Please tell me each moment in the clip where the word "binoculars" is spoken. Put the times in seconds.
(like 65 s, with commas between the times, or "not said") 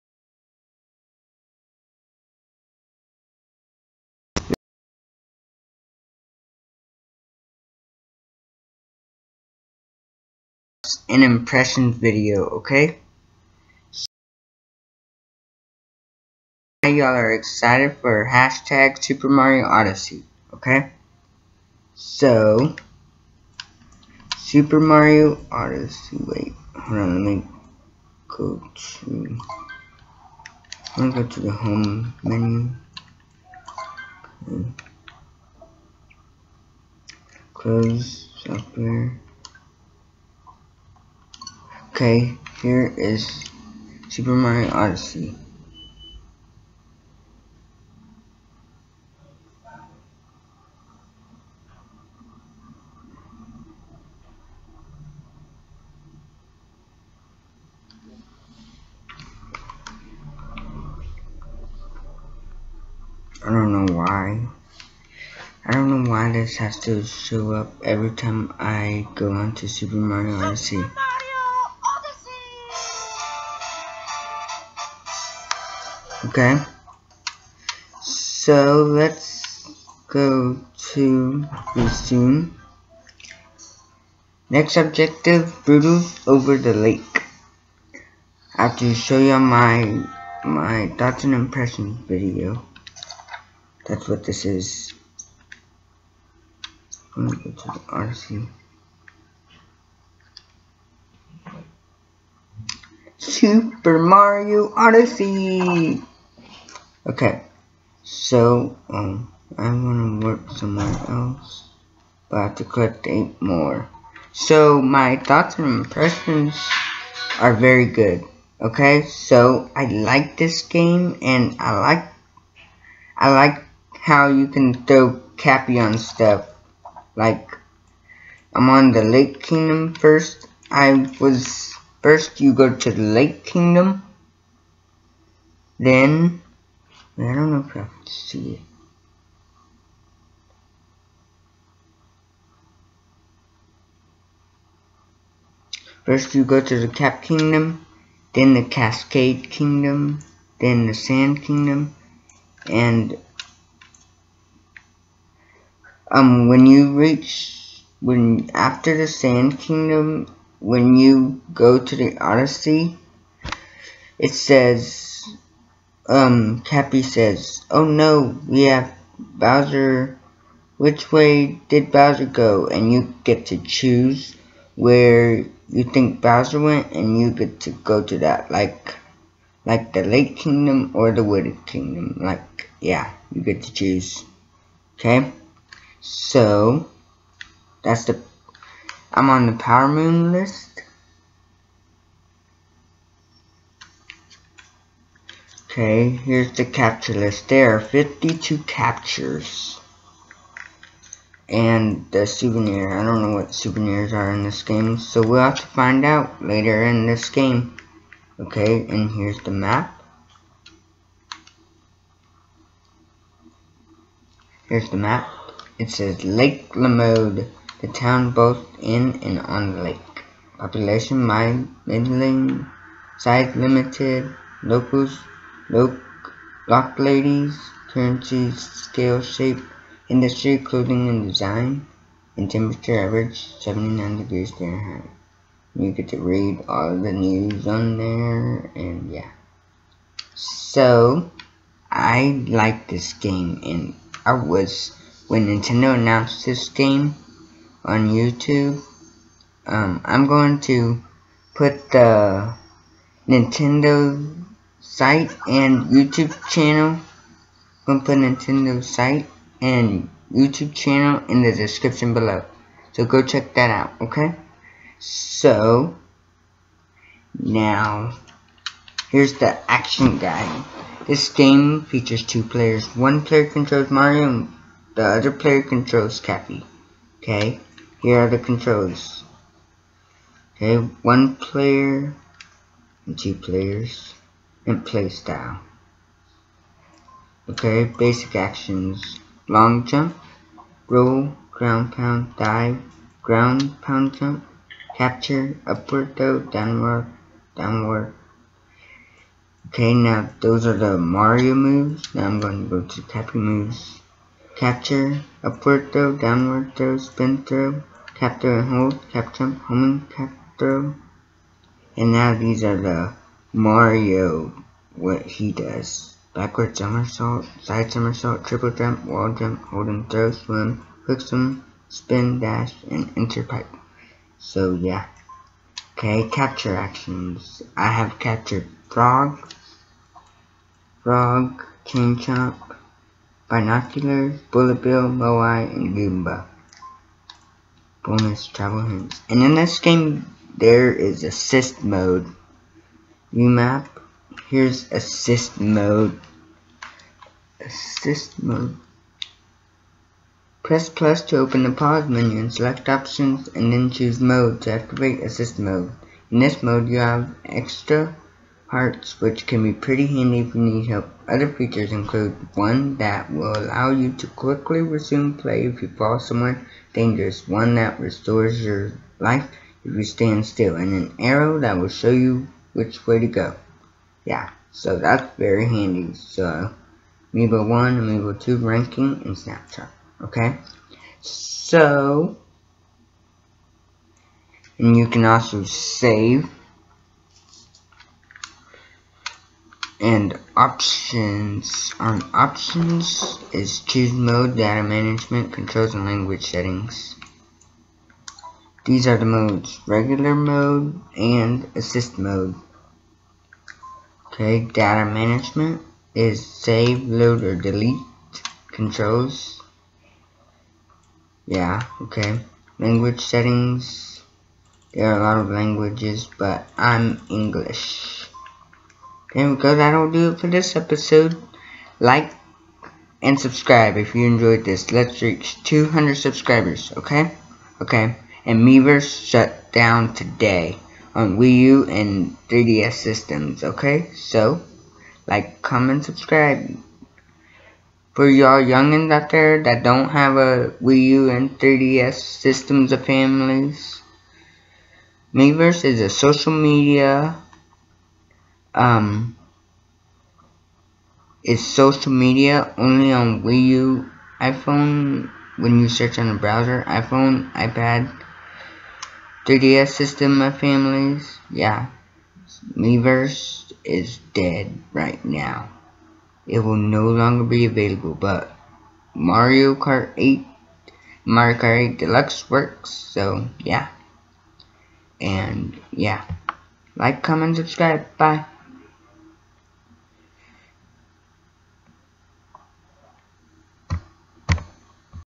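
333 s.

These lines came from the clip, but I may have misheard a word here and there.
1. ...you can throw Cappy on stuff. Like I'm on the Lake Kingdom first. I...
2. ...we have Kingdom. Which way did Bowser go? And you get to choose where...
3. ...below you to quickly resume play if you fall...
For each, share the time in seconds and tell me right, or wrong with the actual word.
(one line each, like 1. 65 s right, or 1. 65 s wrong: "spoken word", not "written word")
1. 124 s right
2. 168 s wrong: "Bowser", not "Kingdom"
3. 363 s wrong: "allow", not "below".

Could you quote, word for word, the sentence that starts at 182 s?
Like, yeah, you get to choose.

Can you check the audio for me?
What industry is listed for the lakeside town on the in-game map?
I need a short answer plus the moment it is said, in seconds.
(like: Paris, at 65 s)
Clothing and design, at 230 s.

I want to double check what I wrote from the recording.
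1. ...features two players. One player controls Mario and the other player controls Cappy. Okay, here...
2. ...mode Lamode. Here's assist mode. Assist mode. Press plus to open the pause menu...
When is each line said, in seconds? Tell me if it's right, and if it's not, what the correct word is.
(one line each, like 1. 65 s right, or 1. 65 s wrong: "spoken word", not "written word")
1. 271 s right
2. 341 s wrong: "UMAP", not "Lamode".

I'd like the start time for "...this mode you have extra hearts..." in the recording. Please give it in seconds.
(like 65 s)
356 s.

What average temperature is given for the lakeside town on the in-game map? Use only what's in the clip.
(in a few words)
79 degrees Fahrenheit.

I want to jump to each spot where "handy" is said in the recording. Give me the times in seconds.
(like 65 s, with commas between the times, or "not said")
360 s, 375 s.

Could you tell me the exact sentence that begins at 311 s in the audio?
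And now these are the Mario, what he does.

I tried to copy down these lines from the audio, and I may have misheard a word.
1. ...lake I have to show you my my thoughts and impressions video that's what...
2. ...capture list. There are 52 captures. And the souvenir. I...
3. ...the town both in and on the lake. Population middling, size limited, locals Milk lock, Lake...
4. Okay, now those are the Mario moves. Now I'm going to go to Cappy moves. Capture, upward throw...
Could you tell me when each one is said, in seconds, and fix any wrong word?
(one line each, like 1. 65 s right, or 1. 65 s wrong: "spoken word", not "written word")
1. 86 s right
2. 196 s right
3. 217 s wrong: "Ladies", not "Lake"
4. 299 s right.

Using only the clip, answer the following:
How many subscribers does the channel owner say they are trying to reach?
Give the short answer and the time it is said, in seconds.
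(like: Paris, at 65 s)
200, at 425 s.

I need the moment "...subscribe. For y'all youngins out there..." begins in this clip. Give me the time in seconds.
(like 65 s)
436 s.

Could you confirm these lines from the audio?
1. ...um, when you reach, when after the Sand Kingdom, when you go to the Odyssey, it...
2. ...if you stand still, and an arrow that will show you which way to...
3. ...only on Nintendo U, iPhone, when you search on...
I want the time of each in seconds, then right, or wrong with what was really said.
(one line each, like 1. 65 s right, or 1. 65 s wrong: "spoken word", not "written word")
1. 156 s right
2. 369 s right
3. 452 s wrong: "Wii", not "Nintendo".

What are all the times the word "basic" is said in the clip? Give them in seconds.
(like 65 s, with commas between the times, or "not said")
287 s.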